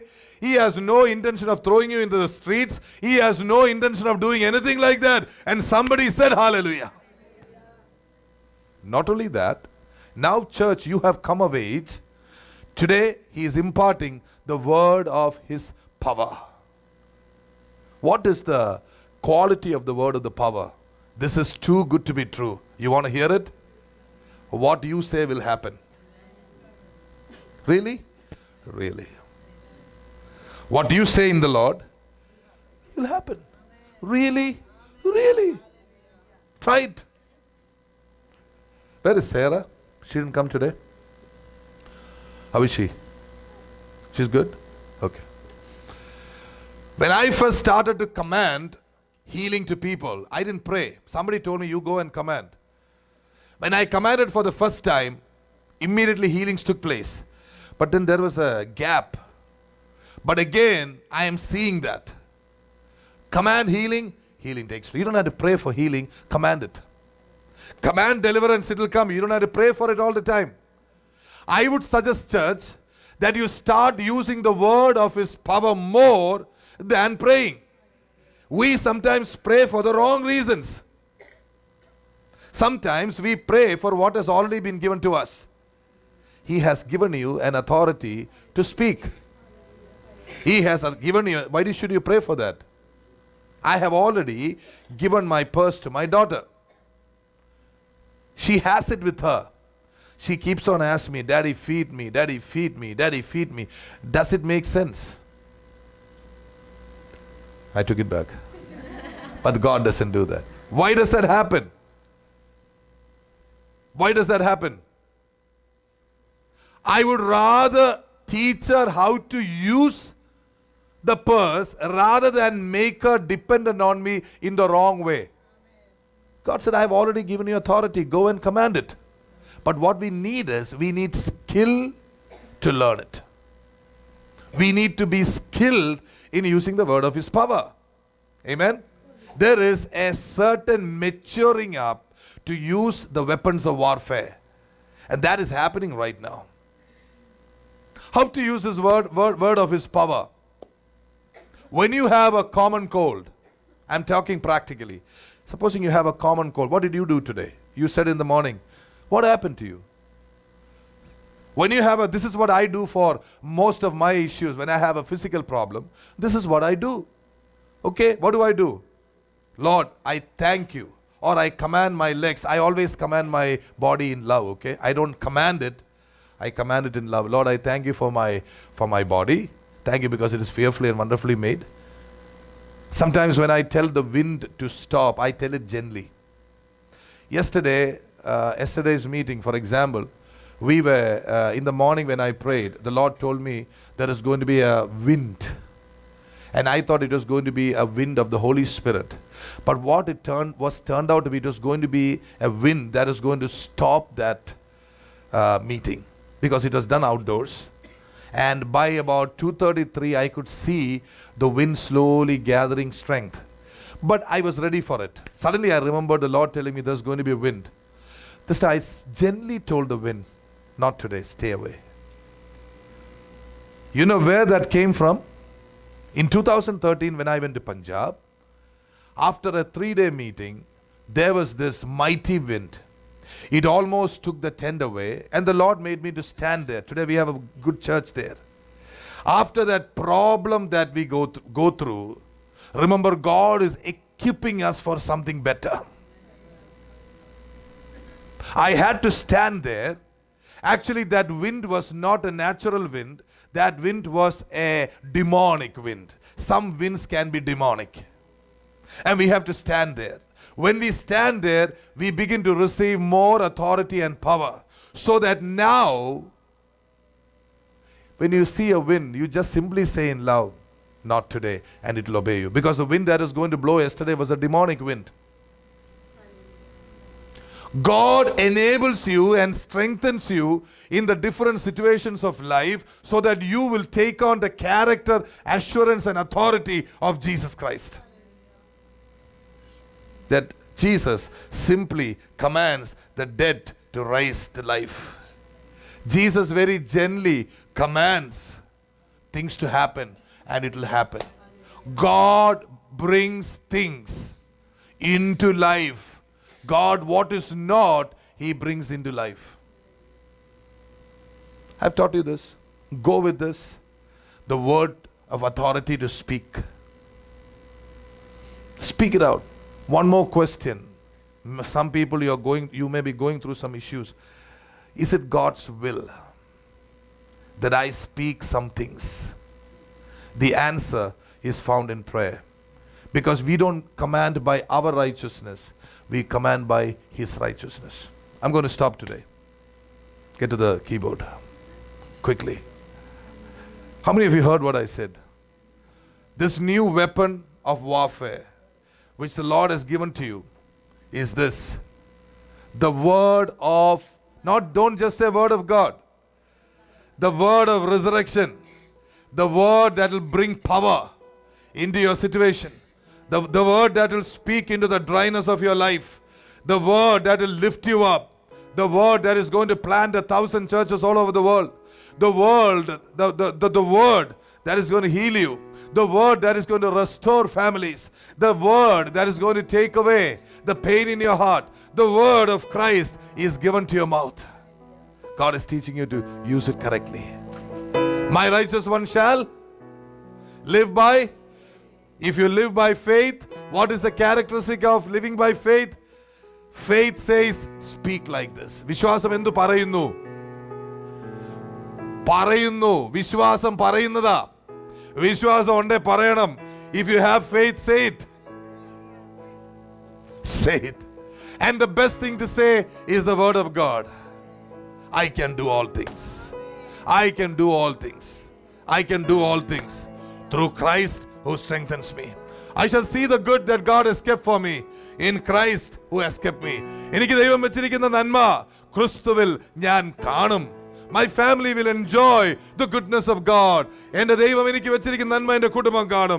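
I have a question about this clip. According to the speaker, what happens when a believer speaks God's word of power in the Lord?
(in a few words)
What you say will happen.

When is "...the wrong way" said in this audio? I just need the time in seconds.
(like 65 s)
124 s.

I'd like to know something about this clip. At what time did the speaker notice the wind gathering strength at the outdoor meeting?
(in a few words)
2:33.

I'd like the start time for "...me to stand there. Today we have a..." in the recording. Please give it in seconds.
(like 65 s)
236 s.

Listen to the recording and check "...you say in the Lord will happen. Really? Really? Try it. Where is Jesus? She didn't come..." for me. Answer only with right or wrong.
wrong.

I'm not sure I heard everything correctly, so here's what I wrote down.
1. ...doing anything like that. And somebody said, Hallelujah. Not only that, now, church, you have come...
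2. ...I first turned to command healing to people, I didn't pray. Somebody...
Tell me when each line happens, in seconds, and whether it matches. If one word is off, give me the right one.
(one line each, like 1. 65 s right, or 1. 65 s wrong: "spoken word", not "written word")
1. 4 s right
2. 47 s wrong: "started", not "turned".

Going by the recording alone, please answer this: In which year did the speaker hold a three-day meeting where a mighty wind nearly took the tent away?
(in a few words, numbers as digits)
2013.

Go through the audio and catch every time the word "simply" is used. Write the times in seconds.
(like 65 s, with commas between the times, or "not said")
269 s, 291 s.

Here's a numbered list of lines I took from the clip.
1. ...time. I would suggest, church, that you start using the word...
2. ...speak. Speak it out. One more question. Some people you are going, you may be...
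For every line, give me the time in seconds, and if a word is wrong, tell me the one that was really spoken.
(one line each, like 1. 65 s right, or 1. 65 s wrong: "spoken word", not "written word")
1. 70 s right
2. 316 s right.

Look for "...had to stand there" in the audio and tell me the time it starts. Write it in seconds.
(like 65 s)
248 s.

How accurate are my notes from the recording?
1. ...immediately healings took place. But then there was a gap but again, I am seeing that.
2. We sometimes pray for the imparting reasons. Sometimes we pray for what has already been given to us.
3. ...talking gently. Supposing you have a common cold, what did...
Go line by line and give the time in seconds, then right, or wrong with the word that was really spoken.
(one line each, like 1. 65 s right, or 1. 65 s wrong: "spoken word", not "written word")
1. 55 s right
2. 78 s wrong: "wrong", not "imparting"
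3. 154 s wrong: "practically", not "gently".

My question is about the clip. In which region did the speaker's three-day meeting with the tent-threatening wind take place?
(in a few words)
Punjab.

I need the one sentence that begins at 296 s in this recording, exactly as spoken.
Jesus very gently commands things to happen and it will happen.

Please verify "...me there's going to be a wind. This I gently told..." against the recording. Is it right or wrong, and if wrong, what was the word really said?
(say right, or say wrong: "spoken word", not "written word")
right.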